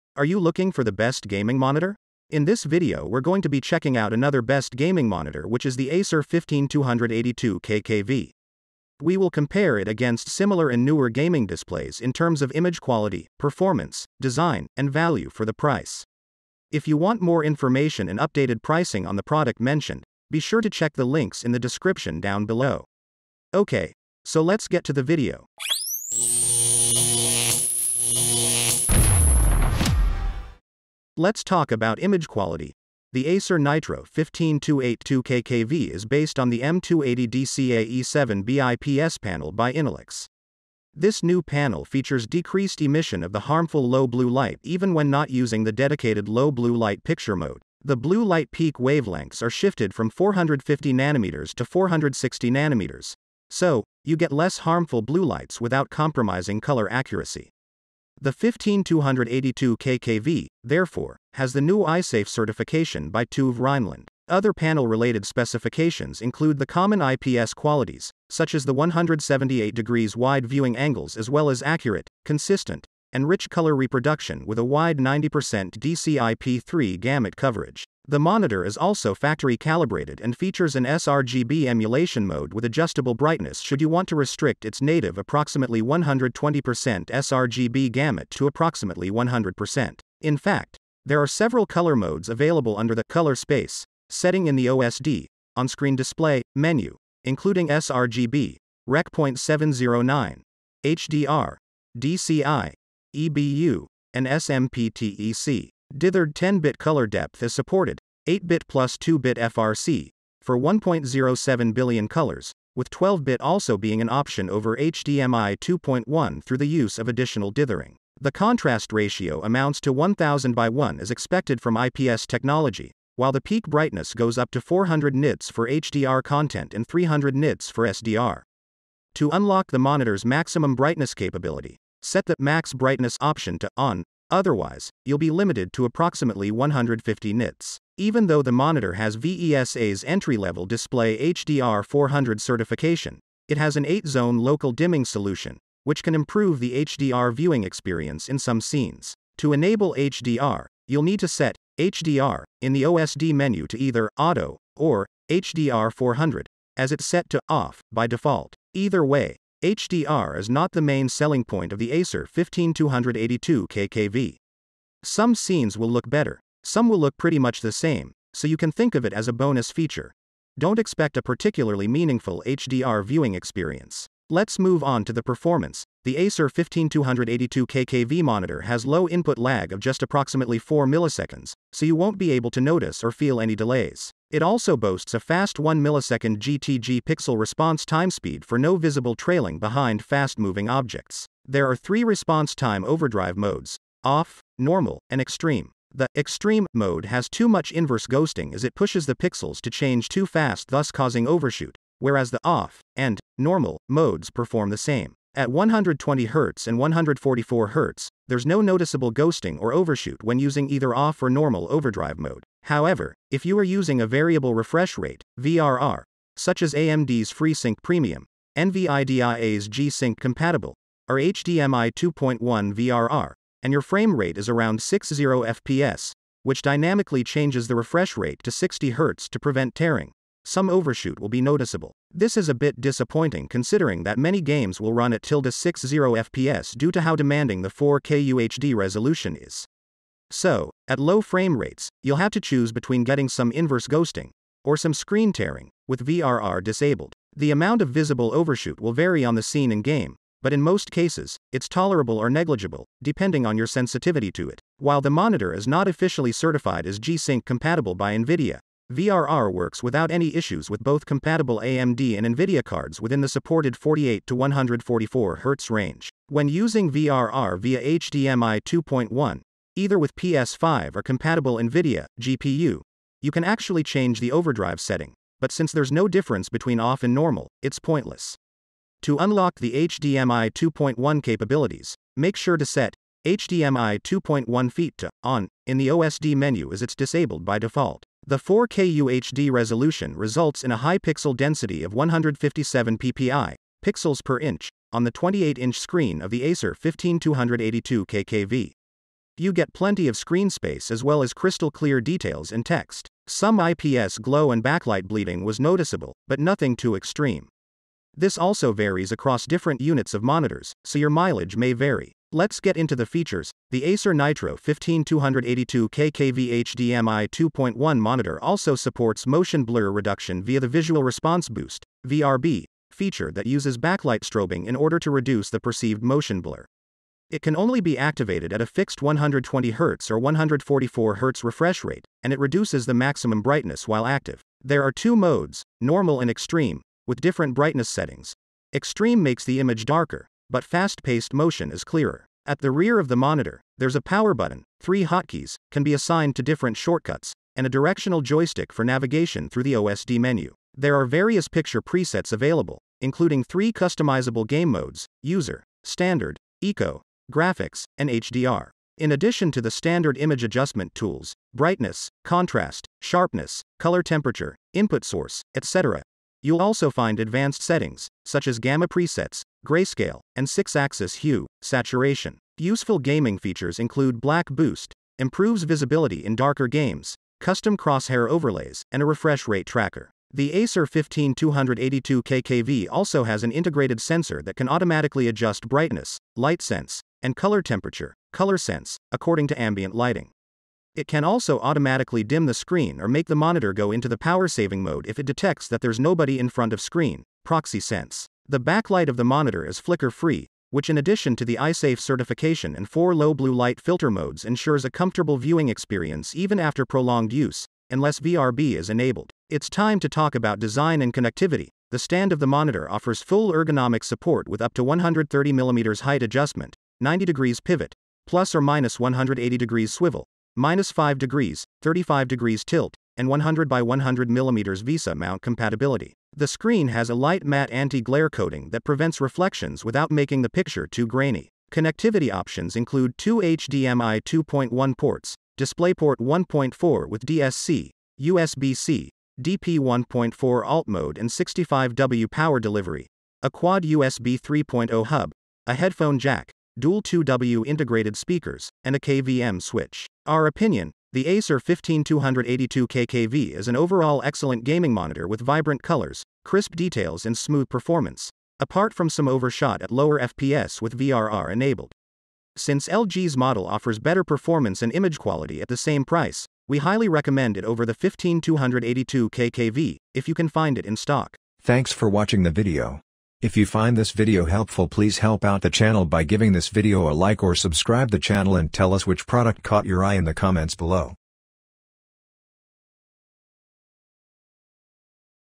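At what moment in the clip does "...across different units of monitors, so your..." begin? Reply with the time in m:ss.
5:09.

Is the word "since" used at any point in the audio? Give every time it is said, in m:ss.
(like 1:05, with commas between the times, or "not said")
4:35, 7:42.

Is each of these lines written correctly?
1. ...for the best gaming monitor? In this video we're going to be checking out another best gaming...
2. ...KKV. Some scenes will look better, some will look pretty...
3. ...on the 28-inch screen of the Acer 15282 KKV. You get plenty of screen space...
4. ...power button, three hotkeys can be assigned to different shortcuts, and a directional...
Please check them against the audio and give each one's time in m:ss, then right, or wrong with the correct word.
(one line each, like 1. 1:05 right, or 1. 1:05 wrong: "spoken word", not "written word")
1. 0:00 right
2. 2:43 right
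3. 4:54 right
4. 5:44 right.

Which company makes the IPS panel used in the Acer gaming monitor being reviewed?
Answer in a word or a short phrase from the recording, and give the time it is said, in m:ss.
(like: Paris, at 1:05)
Innolux, at 0:39.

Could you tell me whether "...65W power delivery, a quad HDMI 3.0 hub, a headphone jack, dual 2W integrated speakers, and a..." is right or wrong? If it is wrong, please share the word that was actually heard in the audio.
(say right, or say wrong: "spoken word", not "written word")
wrong: "USB", not "HDMI".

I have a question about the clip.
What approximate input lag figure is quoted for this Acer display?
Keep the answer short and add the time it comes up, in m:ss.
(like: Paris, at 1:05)
4 milliseconds, at 3:00.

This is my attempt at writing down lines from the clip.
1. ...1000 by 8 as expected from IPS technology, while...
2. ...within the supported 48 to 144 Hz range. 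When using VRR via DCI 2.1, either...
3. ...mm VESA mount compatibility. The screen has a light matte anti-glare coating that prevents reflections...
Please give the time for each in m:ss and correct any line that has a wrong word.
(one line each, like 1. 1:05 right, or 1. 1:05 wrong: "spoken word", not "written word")
1. 1:59 wrong: "1", not "8"
2. 4:23 wrong: "HDMI", not "DCI"
3. 7:04 right.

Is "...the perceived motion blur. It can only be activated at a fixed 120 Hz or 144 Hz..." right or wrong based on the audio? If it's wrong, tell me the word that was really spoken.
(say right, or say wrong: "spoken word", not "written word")
right.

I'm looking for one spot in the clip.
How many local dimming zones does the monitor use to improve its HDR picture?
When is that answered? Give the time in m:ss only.
2:23.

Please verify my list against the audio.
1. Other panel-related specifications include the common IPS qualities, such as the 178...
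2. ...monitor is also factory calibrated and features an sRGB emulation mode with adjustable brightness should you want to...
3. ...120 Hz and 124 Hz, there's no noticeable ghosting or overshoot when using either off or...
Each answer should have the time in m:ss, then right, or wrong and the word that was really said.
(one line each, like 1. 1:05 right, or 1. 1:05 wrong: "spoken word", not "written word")
1. 1:04 right
2. 1:18 right
3. 3:25 wrong: "144", not "124".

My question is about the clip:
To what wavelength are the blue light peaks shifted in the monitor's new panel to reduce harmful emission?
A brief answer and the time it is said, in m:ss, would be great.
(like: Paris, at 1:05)
460 nanometers, at 0:51.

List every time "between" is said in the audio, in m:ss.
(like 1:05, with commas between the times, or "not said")
4:02, 4:36.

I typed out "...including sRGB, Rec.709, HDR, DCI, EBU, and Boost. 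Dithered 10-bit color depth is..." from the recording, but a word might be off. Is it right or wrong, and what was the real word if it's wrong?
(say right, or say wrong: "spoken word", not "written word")
wrong: "SMPTEC", not "Boost".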